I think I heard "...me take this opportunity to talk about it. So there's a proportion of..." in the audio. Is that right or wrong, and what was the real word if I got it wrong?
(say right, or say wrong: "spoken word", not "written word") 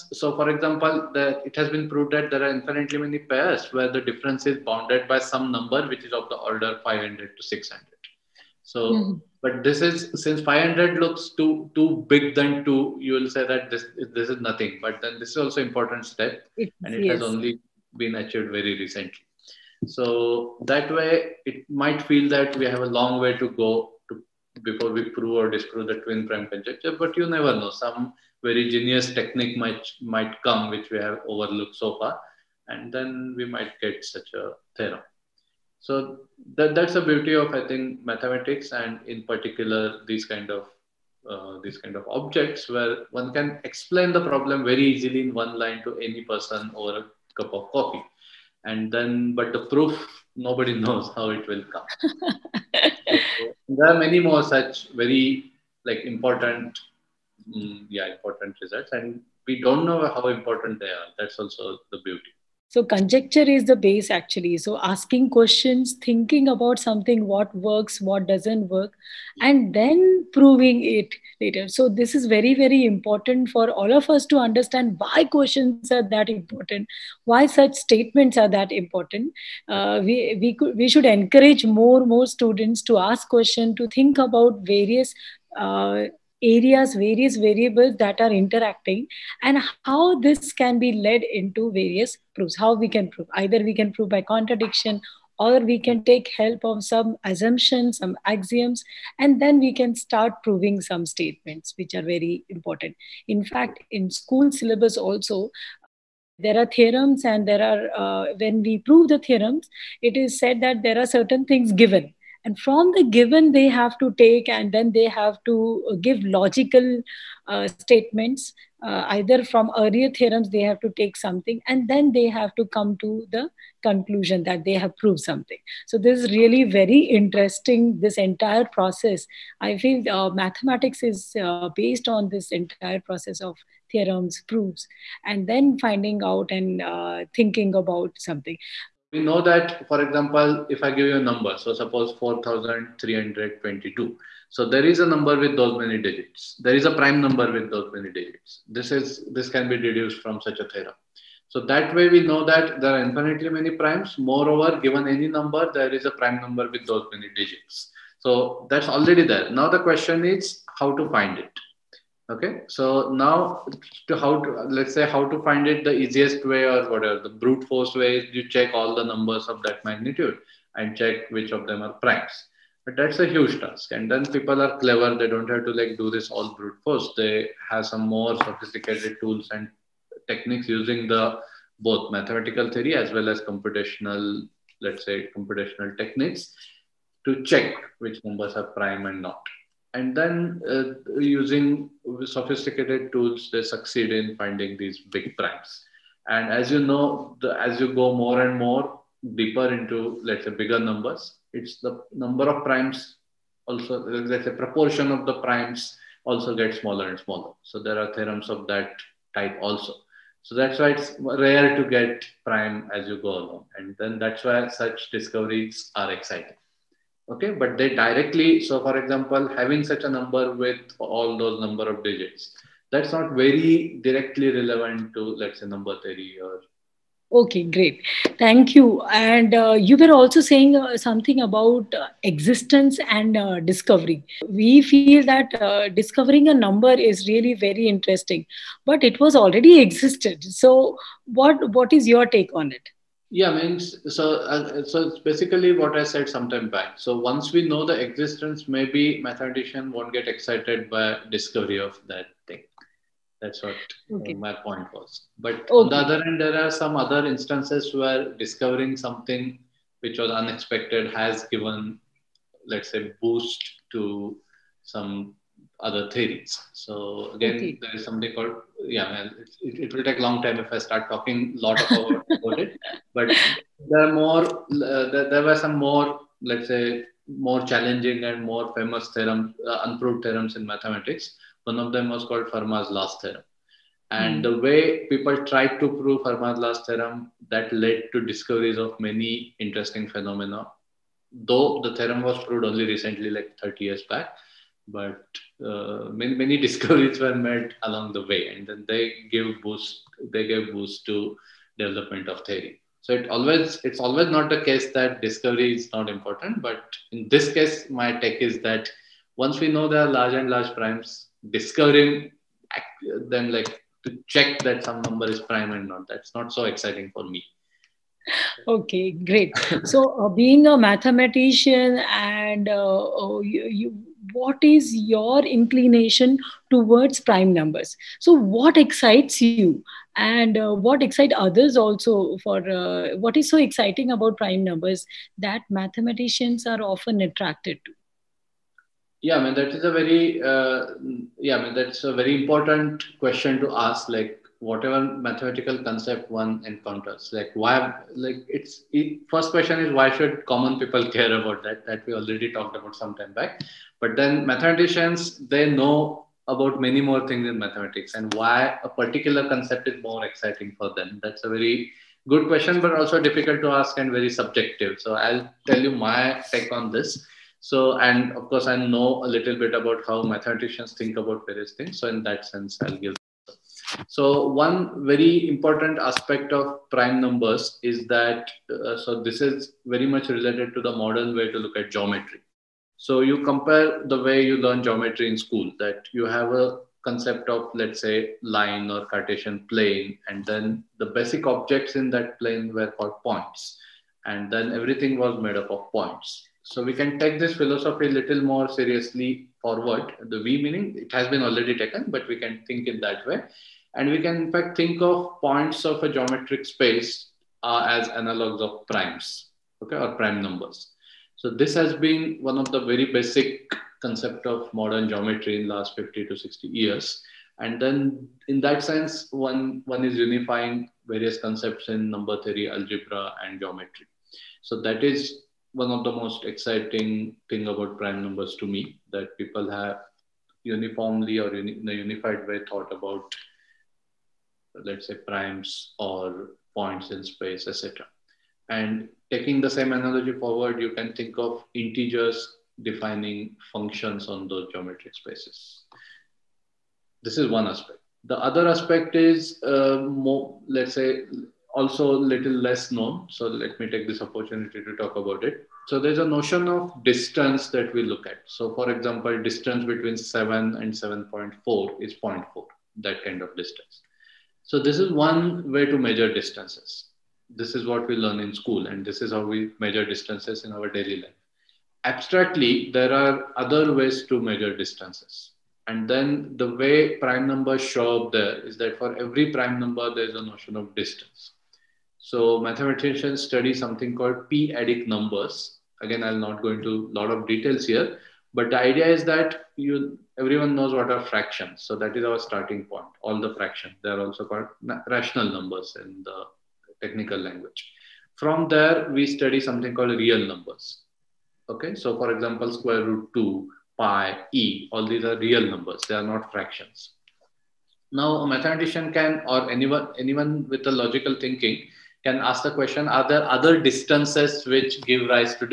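wrong: "notion", not "proportion".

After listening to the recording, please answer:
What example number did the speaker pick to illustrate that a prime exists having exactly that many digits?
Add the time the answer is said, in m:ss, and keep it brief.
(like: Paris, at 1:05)
4,322, at 2:22.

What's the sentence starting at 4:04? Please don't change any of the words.
Uh, so it's basically what I said sometime back.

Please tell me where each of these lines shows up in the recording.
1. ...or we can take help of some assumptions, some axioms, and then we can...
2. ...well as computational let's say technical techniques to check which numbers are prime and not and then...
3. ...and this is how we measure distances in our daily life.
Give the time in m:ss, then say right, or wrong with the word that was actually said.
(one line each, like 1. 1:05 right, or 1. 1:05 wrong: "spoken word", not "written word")
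1. 1:35 right
2. 3:03 wrong: "computational", not "technical"
3. 7:48 right.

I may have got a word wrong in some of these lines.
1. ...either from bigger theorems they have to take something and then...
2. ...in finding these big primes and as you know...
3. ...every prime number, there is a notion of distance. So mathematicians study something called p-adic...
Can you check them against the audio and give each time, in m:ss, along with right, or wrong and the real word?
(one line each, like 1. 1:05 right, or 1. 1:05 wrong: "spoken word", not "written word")
1. 1:59 wrong: "earlier", not "bigger"
2. 3:14 right
3. 7:59 right.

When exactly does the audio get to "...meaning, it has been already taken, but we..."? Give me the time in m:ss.
6:40.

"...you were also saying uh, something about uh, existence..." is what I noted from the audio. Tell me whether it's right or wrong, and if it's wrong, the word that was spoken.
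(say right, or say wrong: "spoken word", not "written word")
right.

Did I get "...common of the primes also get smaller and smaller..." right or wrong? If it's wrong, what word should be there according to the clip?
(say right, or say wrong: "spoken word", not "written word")
wrong: "proportion", not "common".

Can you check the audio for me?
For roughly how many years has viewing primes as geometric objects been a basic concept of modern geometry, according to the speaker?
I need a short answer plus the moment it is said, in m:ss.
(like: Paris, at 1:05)
50 to 60 years, at 6:55.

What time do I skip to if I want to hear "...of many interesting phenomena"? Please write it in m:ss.
4:48.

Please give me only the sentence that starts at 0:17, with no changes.
has only been achieved very recently.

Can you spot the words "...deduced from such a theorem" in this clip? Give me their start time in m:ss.
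2:29.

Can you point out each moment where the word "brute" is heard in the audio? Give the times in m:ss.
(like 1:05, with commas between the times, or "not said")
2:47, 2:56.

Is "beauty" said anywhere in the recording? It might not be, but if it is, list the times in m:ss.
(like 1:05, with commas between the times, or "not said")
0:37, 1:02.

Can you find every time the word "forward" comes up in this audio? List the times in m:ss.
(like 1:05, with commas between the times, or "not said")
6:39, 7:20.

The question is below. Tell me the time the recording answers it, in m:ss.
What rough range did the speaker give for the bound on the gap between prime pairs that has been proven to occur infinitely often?
0:06.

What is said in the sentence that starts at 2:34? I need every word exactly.
Moreover, given any number, there is a prime number with those many digits.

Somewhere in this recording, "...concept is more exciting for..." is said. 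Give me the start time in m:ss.
5:59.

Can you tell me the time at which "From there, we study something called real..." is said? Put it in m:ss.
8:18.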